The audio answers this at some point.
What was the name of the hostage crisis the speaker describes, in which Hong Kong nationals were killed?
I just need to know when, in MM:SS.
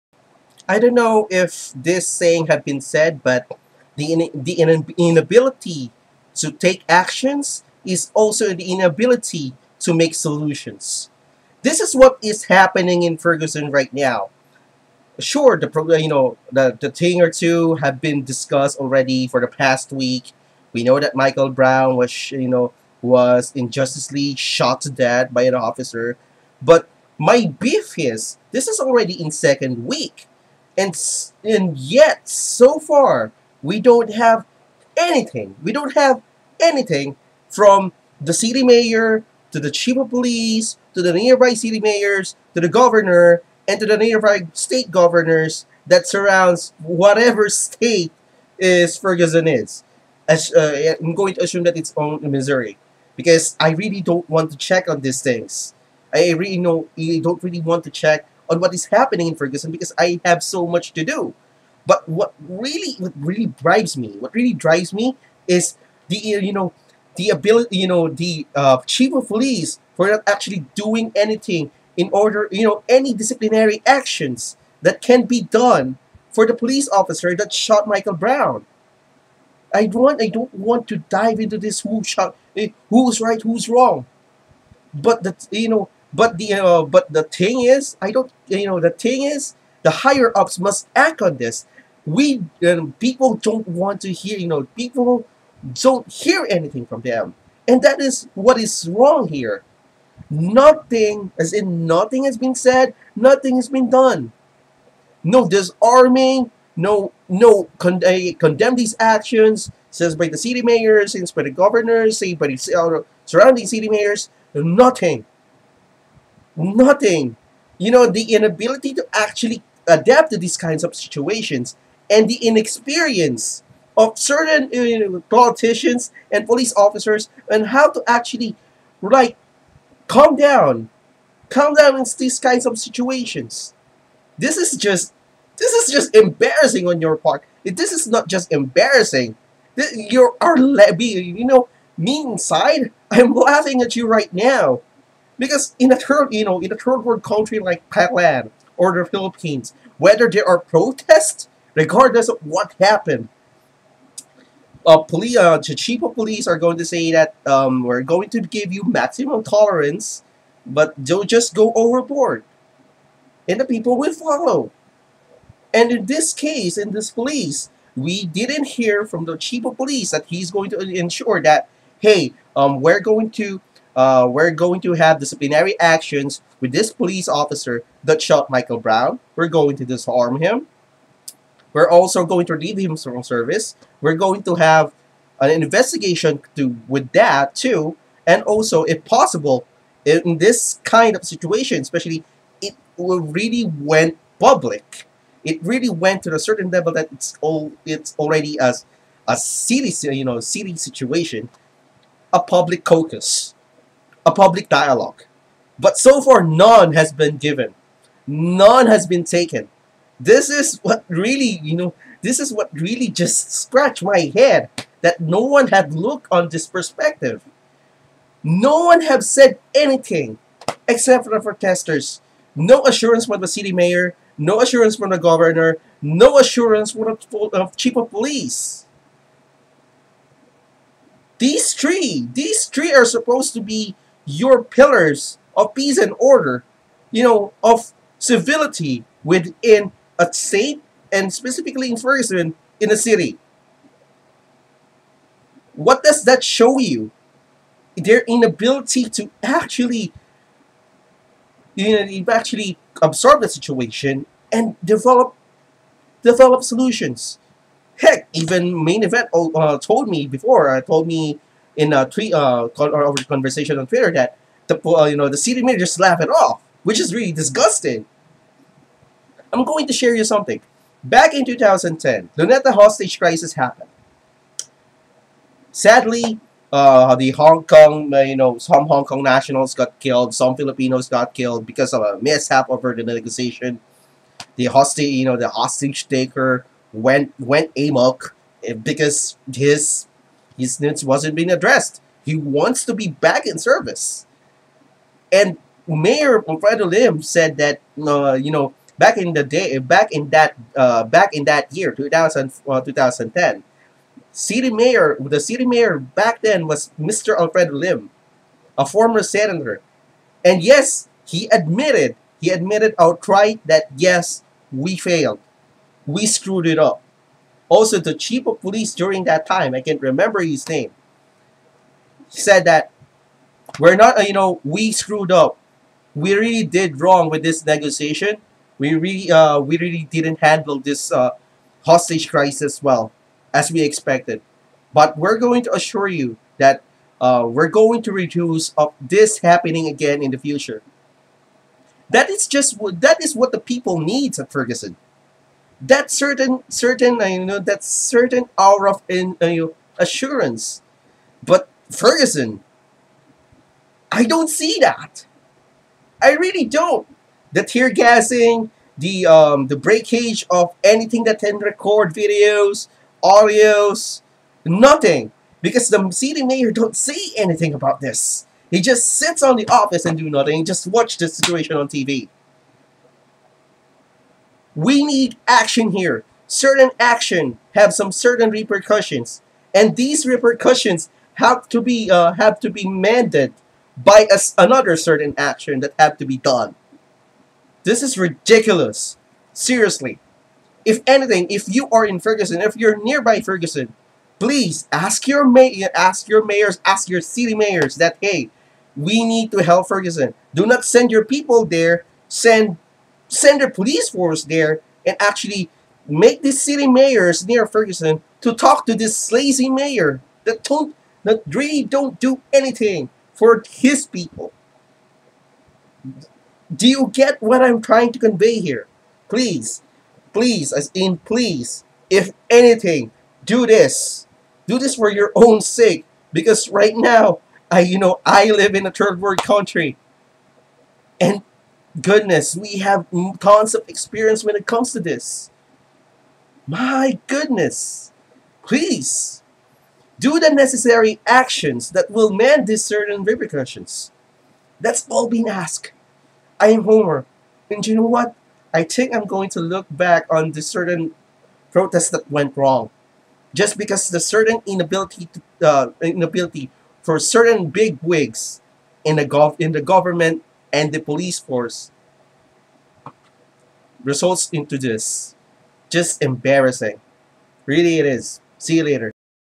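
04:32.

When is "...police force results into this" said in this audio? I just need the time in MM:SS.
07:40.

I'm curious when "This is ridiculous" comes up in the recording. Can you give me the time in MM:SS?
06:27.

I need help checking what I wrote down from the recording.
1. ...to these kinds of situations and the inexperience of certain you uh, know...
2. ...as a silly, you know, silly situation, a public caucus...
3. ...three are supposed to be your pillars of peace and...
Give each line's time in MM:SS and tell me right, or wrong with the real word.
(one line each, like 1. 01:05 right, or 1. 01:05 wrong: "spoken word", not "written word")
1. 02:00 right
2. 03:18 right
3. 03:52 right.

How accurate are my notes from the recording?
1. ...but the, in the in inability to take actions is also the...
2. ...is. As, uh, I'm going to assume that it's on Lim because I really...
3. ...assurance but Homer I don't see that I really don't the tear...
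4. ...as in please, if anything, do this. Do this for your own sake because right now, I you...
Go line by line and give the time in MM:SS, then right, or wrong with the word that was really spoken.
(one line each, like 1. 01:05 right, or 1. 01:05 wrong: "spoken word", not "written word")
1. 00:03 right
2. 00:49 wrong: "Missouri", not "Lim"
3. 05:49 wrong: "Ferguson", not "Homer"
4. 07:00 right.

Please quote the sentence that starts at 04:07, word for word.
Their inability to actually you know, you actually absorb the situation and develop develop solutions.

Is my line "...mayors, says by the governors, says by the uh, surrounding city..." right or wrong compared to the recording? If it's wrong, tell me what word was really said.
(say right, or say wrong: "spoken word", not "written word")
right.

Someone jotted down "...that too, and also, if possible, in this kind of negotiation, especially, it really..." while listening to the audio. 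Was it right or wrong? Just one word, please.
wrong.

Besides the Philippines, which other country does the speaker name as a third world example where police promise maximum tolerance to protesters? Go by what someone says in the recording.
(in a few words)
Thailand.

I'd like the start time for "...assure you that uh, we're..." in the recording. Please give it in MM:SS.
05:35.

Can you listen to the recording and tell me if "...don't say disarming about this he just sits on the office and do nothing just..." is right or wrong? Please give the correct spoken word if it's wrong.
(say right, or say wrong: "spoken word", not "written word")
wrong: "anything", not "disarming".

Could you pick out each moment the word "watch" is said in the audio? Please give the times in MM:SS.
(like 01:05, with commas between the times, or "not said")
06:10.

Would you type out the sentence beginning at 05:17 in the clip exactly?
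Also, the chief of police during that time, I can't remember his name, said that we're not, you know, we screwed up.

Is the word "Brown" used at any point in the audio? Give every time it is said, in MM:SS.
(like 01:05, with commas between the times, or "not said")
00:21, 01:18, 02:58.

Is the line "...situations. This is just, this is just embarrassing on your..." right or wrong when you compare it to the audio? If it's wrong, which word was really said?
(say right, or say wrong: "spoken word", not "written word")
right.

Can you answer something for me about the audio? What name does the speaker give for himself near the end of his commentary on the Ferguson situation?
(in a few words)
Homer.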